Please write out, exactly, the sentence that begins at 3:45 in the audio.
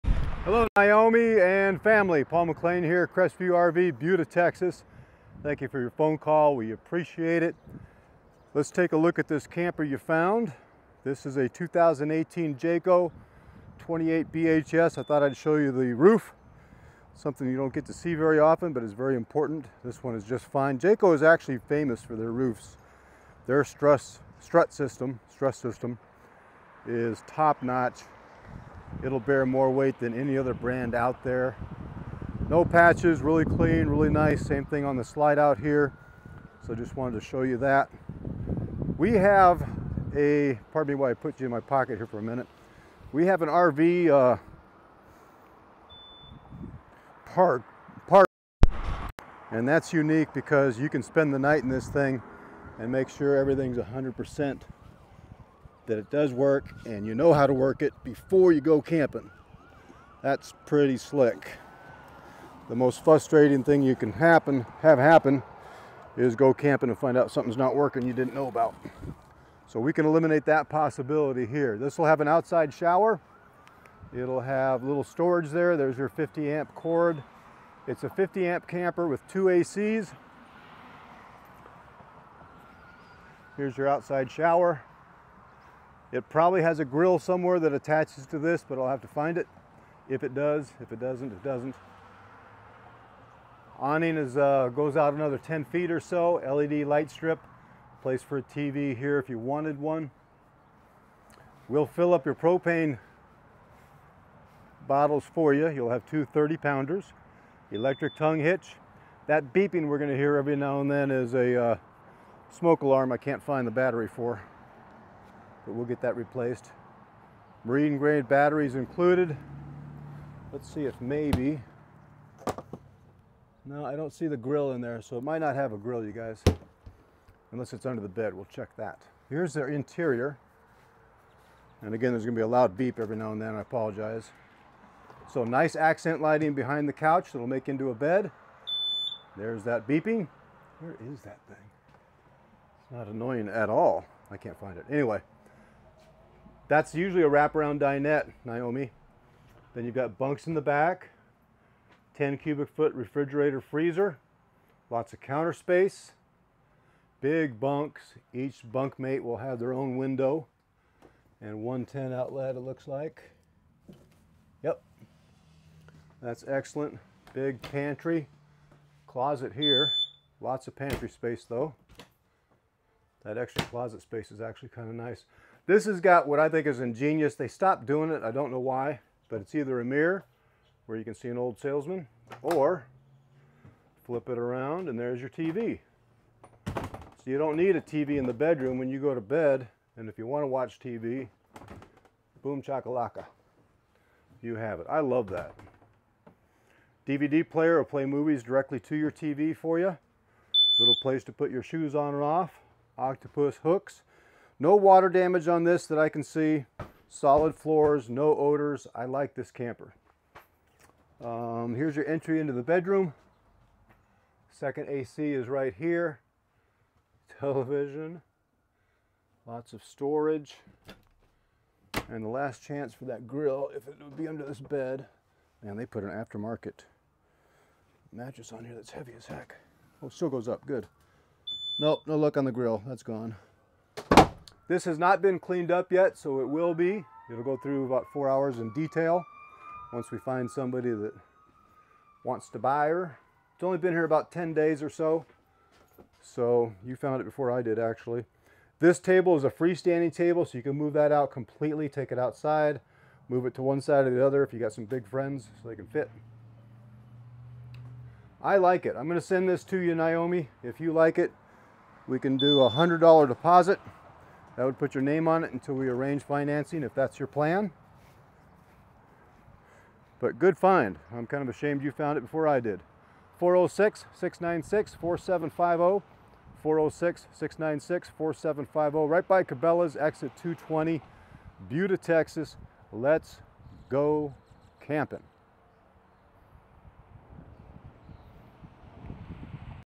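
Man, they put an aftermarket mattress on here that's heavy as heck.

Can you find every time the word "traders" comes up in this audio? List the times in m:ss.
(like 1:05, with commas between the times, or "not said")
not said.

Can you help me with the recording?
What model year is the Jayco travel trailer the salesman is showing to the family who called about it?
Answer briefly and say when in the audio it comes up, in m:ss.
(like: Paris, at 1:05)
2018, at 0:11.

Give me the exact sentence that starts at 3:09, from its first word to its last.
And if you want to watch TV, boom chakalaka, you have it.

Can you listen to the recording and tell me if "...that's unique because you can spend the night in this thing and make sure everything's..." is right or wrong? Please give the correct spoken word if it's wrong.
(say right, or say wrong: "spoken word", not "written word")
right.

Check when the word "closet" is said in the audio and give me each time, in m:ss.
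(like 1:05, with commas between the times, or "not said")
2:49, 2:53.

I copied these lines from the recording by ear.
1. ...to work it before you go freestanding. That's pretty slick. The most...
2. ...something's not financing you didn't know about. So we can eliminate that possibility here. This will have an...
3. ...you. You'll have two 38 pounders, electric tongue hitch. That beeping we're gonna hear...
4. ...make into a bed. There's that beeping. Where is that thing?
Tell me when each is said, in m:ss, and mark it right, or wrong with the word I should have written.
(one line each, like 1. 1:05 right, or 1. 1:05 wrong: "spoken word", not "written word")
1. 0:57 wrong: "camping", not "freestanding"
2. 1:07 wrong: "working", not "financing"
3. 1:45 wrong: "30", not "38"
4. 2:17 right.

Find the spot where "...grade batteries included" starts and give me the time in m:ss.
1:57.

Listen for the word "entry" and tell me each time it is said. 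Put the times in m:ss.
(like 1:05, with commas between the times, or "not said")
3:32.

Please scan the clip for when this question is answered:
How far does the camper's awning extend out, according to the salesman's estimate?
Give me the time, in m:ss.
1:35.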